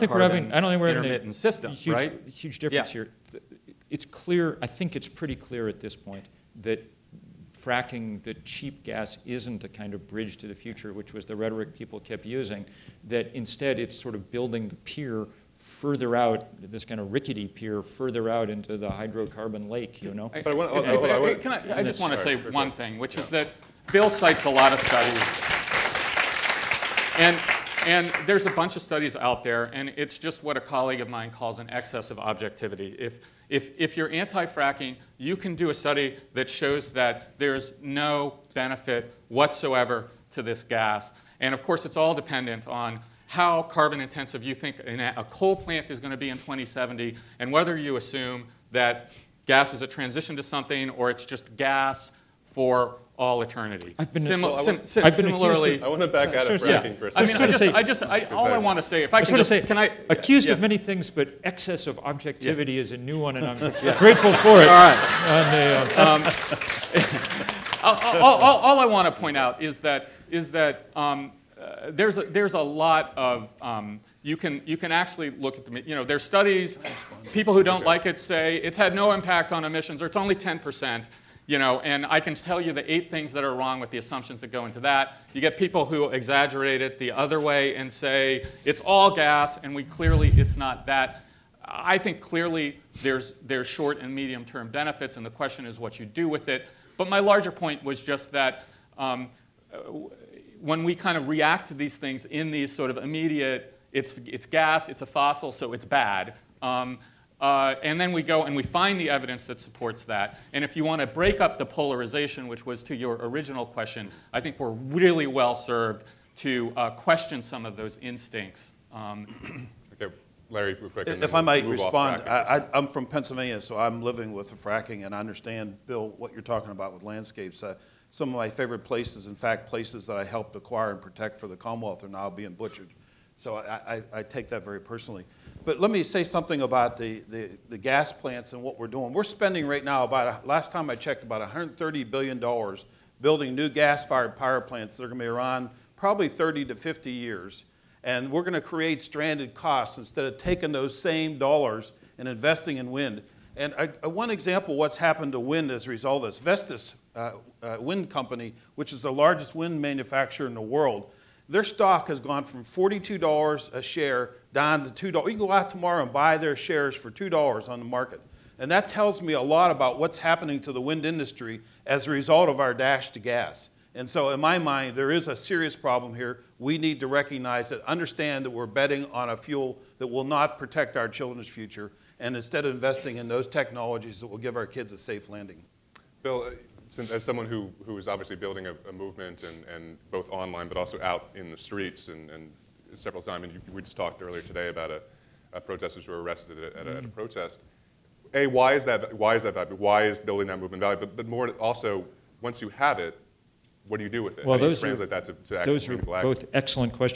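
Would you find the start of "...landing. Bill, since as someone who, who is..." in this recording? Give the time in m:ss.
3:05.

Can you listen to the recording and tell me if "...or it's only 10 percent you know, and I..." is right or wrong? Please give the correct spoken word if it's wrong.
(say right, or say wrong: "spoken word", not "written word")
right.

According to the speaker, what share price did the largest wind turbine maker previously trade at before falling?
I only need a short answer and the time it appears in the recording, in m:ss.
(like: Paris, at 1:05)
$42, at 2:42.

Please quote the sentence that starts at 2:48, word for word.
And that tells me a lot about what's happening to the wind industry as a result of our dash to gas.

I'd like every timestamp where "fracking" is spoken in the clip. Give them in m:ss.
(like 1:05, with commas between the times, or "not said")
0:07, 0:34, 0:56, 2:04.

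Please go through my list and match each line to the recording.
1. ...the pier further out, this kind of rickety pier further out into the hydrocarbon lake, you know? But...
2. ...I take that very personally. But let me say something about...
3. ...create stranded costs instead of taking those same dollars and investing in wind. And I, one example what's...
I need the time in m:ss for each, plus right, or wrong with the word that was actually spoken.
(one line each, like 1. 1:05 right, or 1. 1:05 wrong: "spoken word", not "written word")
1. 0:14 right
2. 2:14 right
3. 2:28 right.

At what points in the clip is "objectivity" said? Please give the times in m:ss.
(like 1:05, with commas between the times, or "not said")
0:32, 1:01.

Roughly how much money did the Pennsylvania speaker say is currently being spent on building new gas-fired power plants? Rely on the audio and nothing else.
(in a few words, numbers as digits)
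$130 billion.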